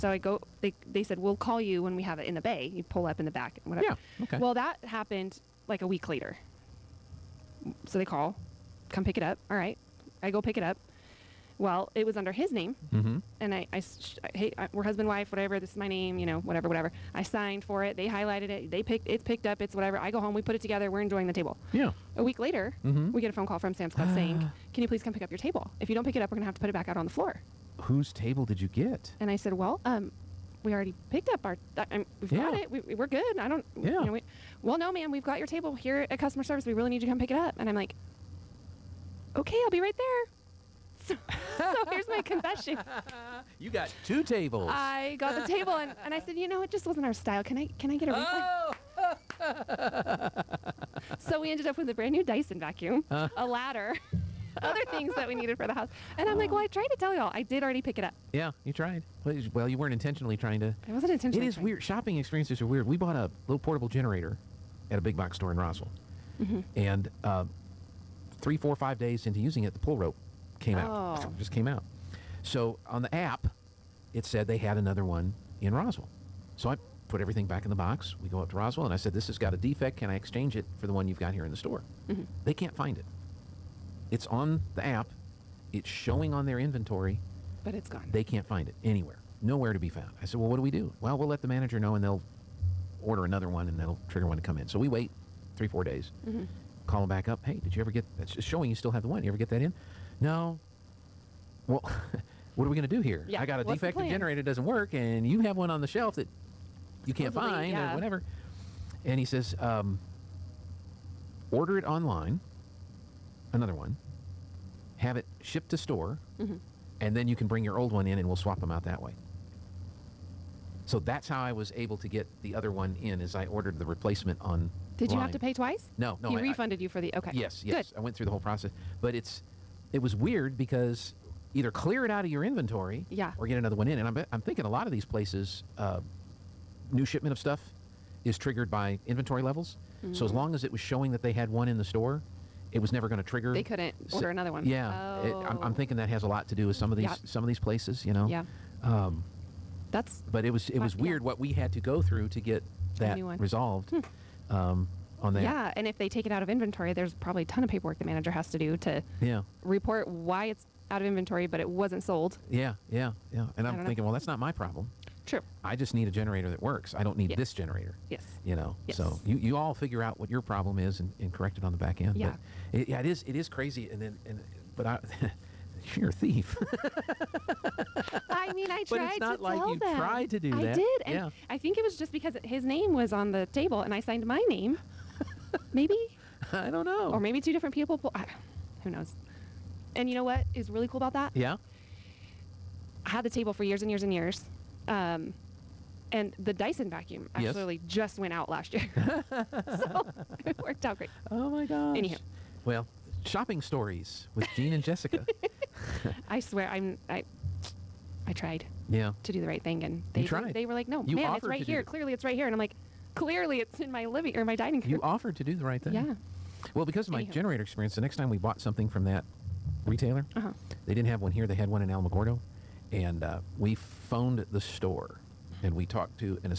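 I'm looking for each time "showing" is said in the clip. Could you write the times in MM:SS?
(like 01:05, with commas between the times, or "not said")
01:25, 01:38, 02:20.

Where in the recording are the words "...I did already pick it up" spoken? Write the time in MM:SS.
00:57.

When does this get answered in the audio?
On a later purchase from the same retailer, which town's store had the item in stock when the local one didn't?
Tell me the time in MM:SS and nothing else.
03:41.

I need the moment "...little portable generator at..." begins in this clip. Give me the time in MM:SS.
01:03.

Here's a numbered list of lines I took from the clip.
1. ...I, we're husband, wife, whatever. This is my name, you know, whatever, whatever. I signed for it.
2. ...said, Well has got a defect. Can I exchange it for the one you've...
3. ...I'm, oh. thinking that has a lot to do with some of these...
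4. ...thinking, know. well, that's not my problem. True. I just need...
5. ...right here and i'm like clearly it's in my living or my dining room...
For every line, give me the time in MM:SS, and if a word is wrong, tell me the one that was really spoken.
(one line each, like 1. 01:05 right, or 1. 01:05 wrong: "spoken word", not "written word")
1. 00:14 right
2. 01:18 wrong: "This", not "Well"
3. 02:25 right
4. 02:43 right
5. 03:32 right.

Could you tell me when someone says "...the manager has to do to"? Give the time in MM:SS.
02:37.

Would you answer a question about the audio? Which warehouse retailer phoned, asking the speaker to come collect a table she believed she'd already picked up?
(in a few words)
Sam's Club.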